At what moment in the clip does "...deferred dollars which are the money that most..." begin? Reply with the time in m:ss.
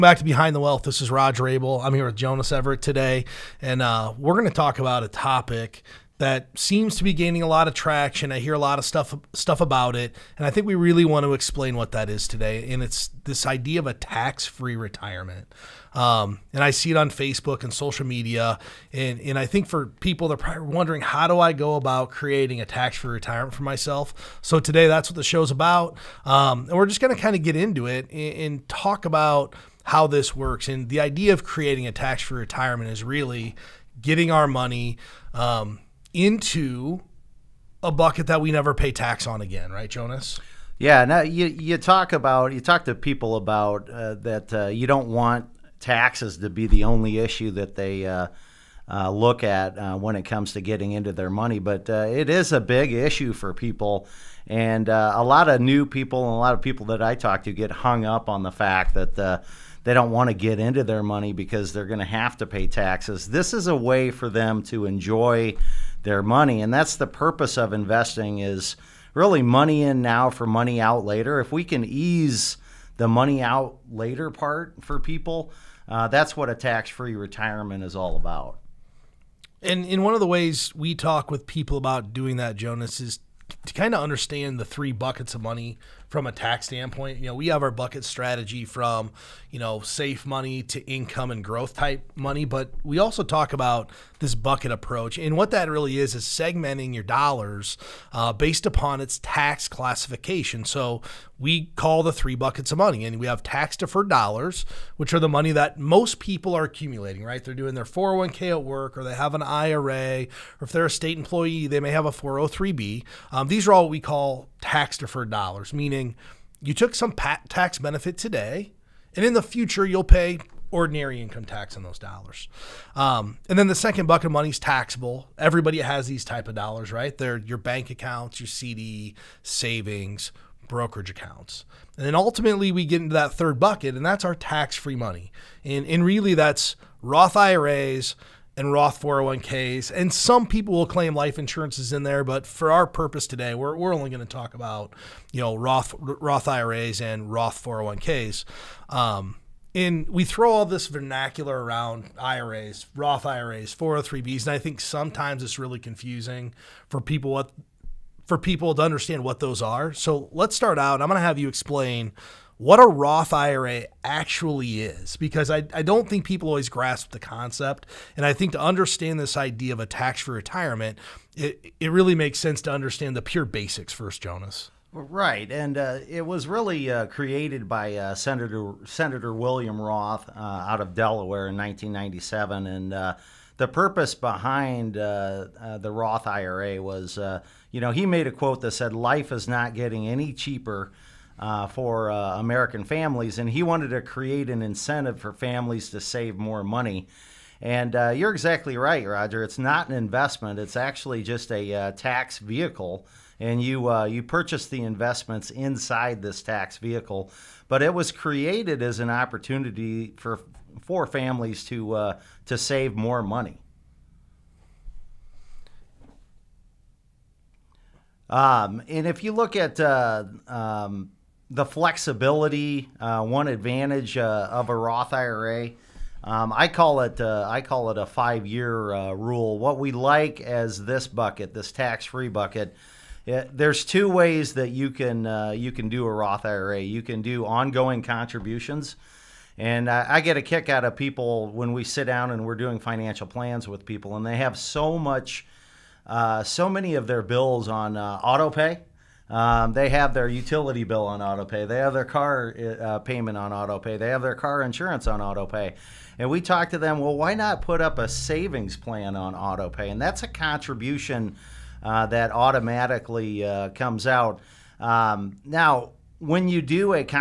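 1:43.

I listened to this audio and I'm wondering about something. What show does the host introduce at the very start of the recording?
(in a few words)
Behind the Wealth.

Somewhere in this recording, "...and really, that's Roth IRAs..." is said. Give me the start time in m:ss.
2:15.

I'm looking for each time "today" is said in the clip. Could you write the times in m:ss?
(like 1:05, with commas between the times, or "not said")
0:02, 0:12, 0:24, 1:58, 2:23.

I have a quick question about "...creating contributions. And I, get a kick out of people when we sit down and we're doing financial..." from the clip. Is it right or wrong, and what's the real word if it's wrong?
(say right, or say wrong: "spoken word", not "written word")
wrong: "ongoing", not "creating".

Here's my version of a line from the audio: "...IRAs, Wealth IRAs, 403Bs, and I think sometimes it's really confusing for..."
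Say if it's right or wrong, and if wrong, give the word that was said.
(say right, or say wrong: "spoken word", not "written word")
wrong: "Roth", not "Wealth".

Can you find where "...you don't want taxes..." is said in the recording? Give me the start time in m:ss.
0:44.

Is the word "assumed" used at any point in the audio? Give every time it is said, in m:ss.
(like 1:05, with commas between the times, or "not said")
not said.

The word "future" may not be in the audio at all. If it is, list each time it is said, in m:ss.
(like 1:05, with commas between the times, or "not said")
1:59.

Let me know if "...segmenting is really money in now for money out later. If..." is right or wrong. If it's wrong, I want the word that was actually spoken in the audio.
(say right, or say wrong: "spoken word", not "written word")
wrong: "investing", not "segmenting".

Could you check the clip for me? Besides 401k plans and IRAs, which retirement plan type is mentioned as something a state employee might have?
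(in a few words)
403b.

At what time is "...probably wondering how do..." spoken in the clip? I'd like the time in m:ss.
0:20.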